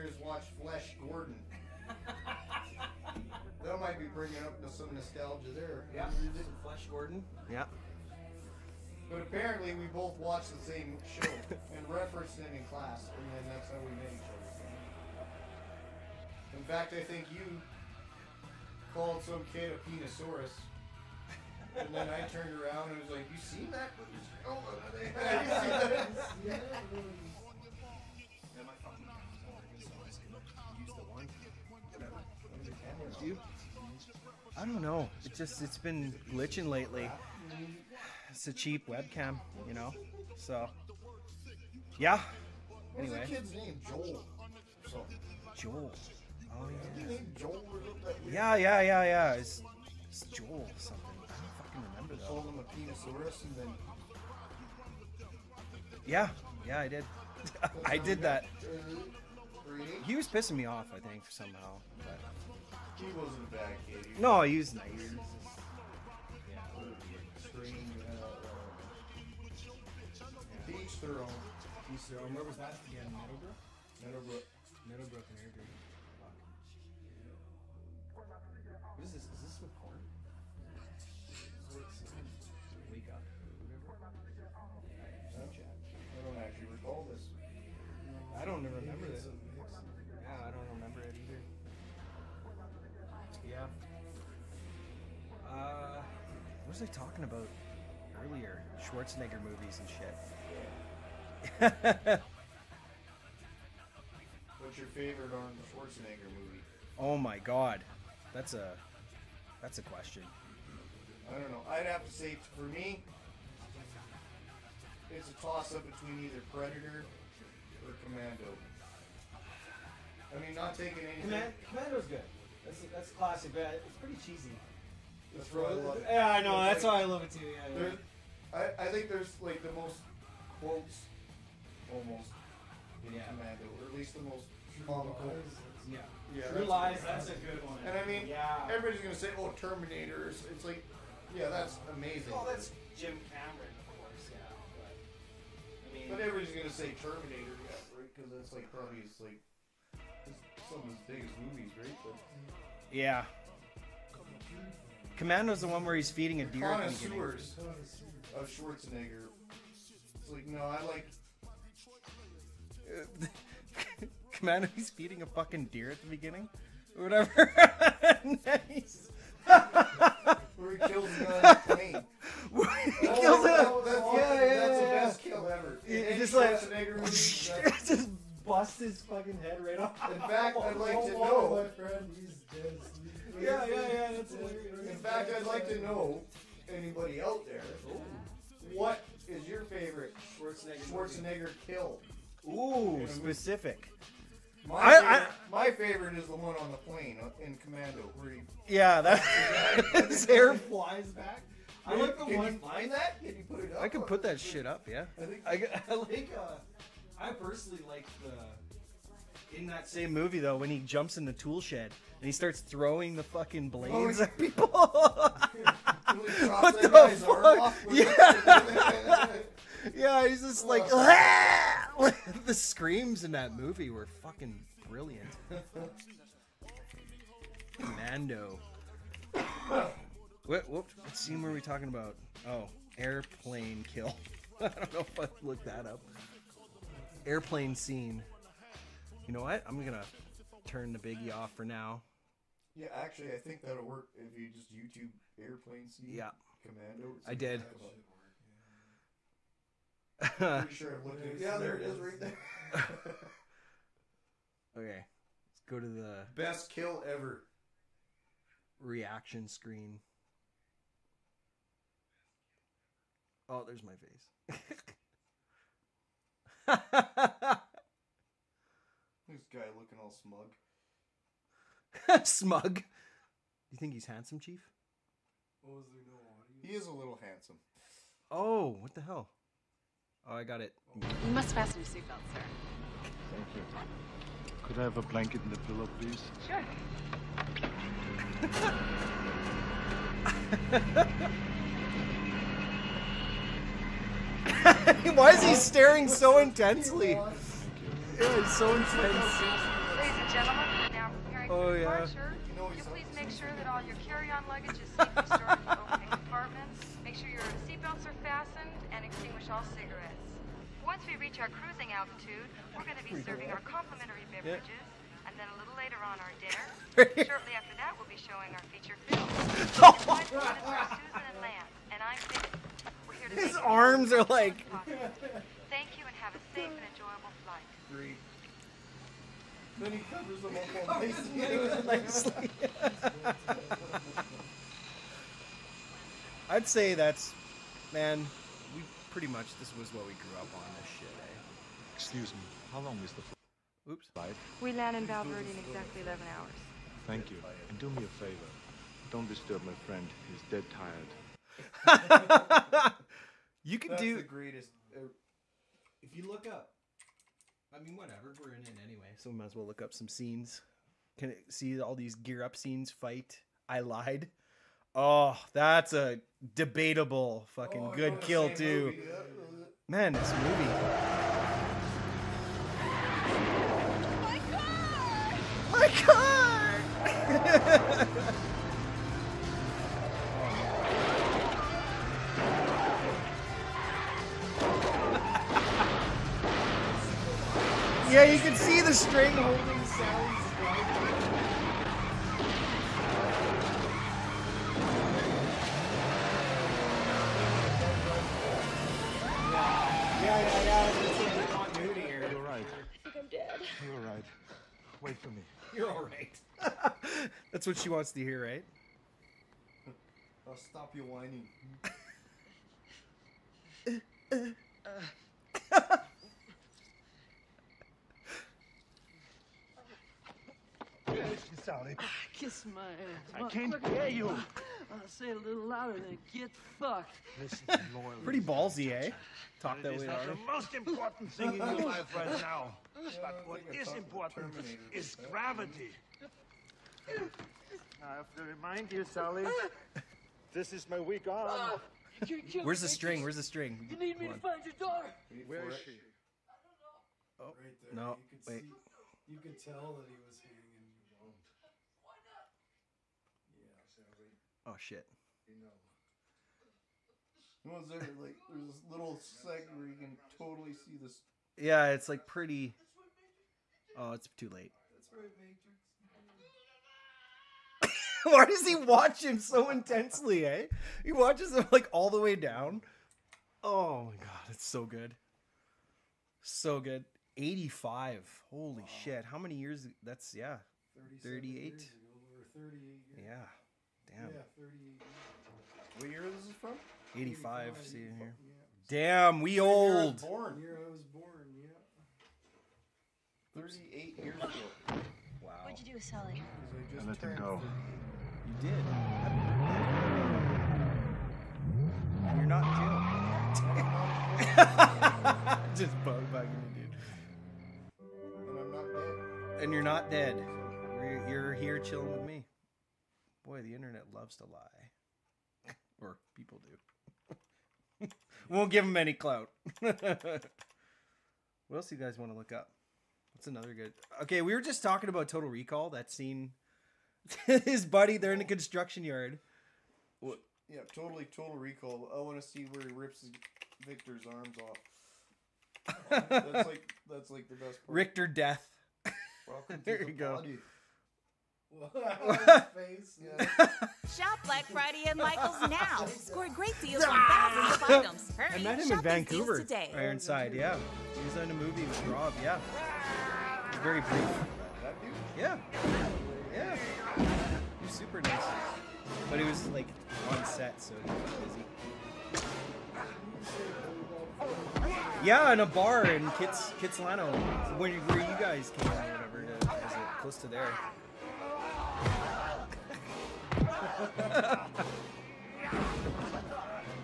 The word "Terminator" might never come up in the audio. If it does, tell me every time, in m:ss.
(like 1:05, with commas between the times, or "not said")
2:19, 2:27.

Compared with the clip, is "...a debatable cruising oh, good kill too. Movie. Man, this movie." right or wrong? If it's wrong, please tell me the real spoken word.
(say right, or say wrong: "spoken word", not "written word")
wrong: "fucking", not "cruising".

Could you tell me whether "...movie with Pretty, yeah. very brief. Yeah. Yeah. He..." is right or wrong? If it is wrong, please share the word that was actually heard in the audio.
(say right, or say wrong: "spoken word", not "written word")
wrong: "Rob", not "Pretty".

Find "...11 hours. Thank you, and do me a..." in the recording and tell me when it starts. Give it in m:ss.
5:46.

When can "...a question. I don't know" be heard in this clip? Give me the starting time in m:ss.
1:49.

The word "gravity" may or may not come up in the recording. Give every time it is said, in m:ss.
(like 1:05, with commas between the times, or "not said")
7:15.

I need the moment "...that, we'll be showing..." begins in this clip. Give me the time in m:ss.
5:17.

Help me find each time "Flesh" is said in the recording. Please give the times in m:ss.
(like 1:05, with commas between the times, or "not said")
0:00, 0:06.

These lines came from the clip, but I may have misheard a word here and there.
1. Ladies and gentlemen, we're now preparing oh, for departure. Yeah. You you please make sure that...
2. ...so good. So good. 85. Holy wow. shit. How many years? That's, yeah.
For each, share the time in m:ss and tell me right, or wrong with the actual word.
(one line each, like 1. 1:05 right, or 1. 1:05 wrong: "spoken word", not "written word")
1. 4:58 right
2. 7:54 right.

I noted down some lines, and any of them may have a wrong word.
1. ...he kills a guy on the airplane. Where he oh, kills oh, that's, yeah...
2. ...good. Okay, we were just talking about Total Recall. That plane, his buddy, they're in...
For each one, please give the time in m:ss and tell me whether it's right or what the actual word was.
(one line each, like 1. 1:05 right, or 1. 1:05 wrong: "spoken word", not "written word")
1. 2:50 wrong: "plane", not "airplane"
2. 8:43 wrong: "scene", not "plane".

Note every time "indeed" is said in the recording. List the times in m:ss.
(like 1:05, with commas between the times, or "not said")
not said.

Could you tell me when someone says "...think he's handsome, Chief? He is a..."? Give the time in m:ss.
4:33.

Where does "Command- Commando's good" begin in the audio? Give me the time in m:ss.
2:01.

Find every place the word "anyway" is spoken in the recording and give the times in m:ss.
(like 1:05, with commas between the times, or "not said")
0:42, 5:58.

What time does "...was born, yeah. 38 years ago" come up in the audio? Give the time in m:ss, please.
8:10.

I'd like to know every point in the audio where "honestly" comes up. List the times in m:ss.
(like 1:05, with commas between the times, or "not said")
not said.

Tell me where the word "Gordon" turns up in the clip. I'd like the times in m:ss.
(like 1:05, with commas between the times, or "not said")
0:01, 0:06.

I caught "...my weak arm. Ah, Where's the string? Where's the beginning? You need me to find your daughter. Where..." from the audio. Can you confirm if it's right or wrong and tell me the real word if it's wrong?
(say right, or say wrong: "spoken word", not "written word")
wrong: "string", not "beginning".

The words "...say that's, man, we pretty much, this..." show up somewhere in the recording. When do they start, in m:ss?
5:36.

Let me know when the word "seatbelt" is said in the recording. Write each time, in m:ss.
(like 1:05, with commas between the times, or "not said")
4:41, 5:07.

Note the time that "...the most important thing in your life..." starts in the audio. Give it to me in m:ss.
7:10.